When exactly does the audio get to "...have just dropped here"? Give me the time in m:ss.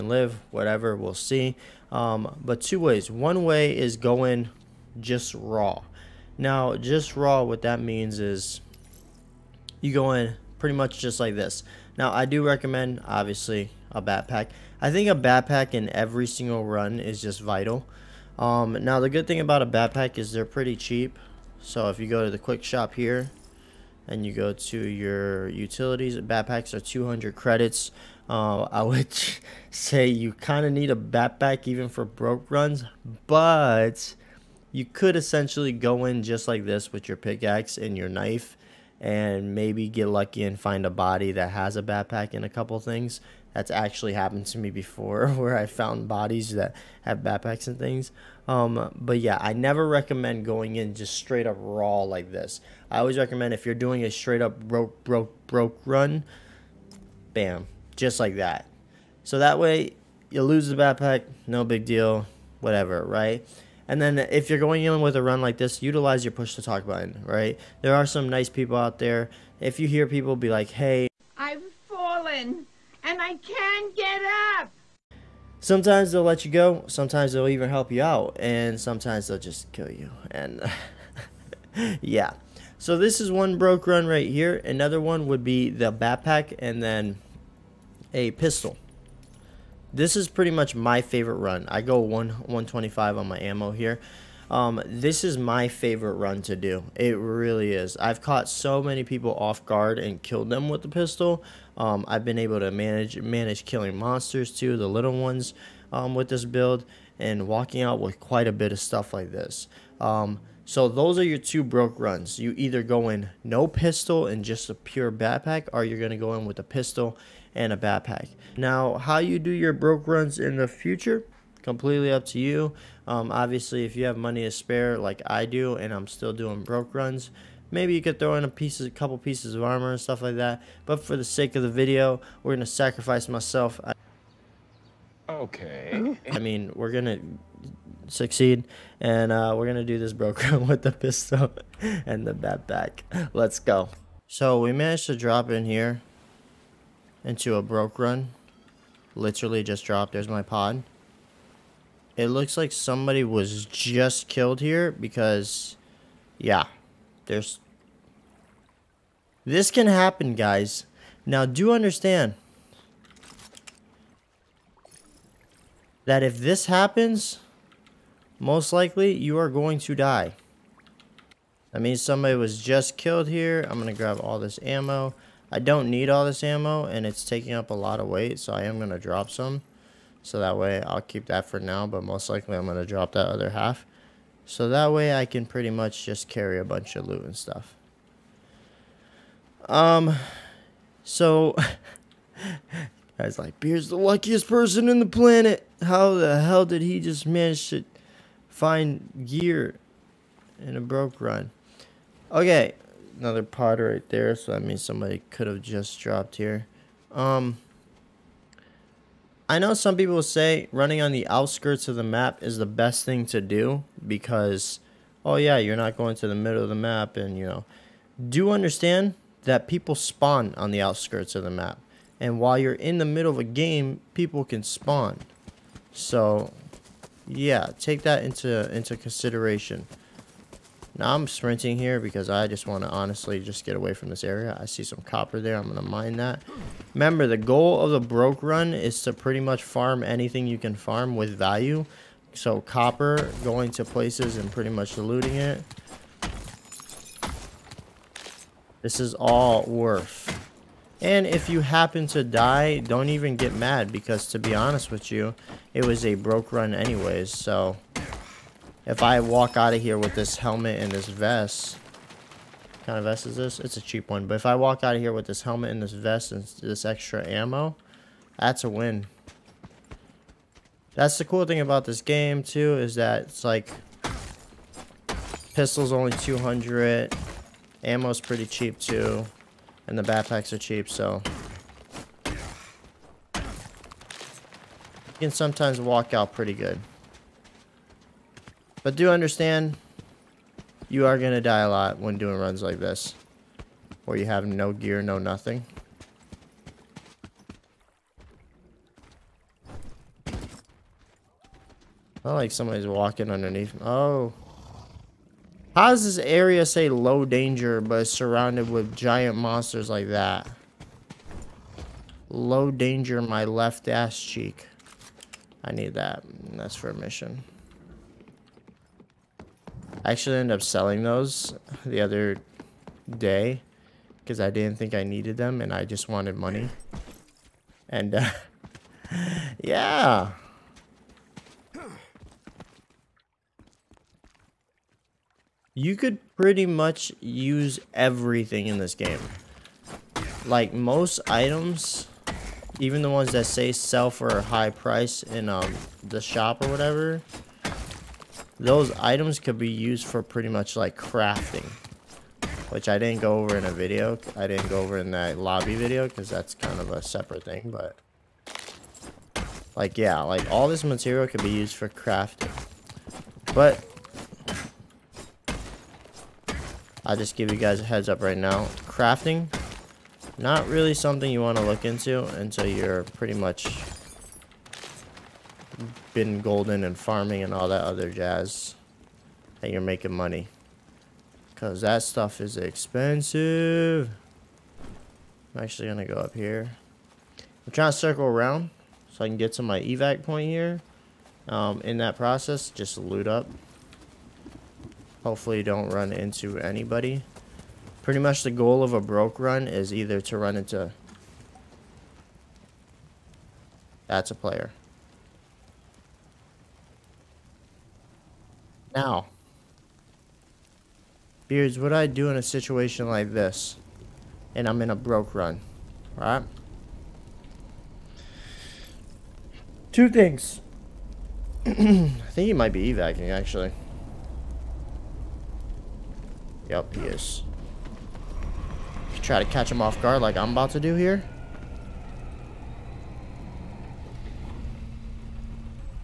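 3:25.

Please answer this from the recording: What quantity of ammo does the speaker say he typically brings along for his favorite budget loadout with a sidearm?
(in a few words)
125.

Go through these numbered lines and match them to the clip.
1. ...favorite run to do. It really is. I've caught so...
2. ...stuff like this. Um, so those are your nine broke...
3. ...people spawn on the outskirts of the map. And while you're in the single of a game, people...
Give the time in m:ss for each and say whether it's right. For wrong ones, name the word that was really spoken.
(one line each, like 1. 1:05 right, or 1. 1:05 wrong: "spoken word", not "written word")
1. 1:35 right
2. 1:48 wrong: "two", not "nine"
3. 3:39 wrong: "middle", not "single".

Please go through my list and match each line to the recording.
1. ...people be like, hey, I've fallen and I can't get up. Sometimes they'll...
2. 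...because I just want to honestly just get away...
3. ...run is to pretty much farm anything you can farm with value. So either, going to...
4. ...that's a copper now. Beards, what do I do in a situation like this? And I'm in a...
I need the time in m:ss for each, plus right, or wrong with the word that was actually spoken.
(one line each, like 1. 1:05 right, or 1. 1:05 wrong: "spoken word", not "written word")
1. 1:10 right
2. 3:51 right
3. 3:58 wrong: "copper", not "either"
4. 6:44 wrong: "player", not "copper".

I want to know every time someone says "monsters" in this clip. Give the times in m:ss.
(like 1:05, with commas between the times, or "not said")
1:43, 5:09.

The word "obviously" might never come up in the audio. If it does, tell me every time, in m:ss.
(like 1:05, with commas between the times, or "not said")
0:13, 2:03.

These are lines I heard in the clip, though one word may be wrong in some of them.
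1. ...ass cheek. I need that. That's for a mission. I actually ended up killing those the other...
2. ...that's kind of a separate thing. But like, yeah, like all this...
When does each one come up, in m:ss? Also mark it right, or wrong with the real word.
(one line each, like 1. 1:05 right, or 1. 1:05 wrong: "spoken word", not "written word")
1. 5:13 wrong: "selling", not "killing"
2. 5:56 right.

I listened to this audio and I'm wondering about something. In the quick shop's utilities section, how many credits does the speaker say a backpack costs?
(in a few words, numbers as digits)
200 credits.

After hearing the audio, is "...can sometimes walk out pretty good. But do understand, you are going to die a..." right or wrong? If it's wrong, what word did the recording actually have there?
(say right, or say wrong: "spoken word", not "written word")
right.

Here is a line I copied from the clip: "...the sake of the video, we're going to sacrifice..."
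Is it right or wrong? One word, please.
right.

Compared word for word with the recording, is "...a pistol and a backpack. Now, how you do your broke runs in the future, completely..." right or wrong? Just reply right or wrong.
right.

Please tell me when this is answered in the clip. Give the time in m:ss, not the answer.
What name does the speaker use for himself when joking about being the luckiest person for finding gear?
3:13.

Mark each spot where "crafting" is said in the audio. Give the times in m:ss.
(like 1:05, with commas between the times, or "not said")
5:50, 6:01, 6:08.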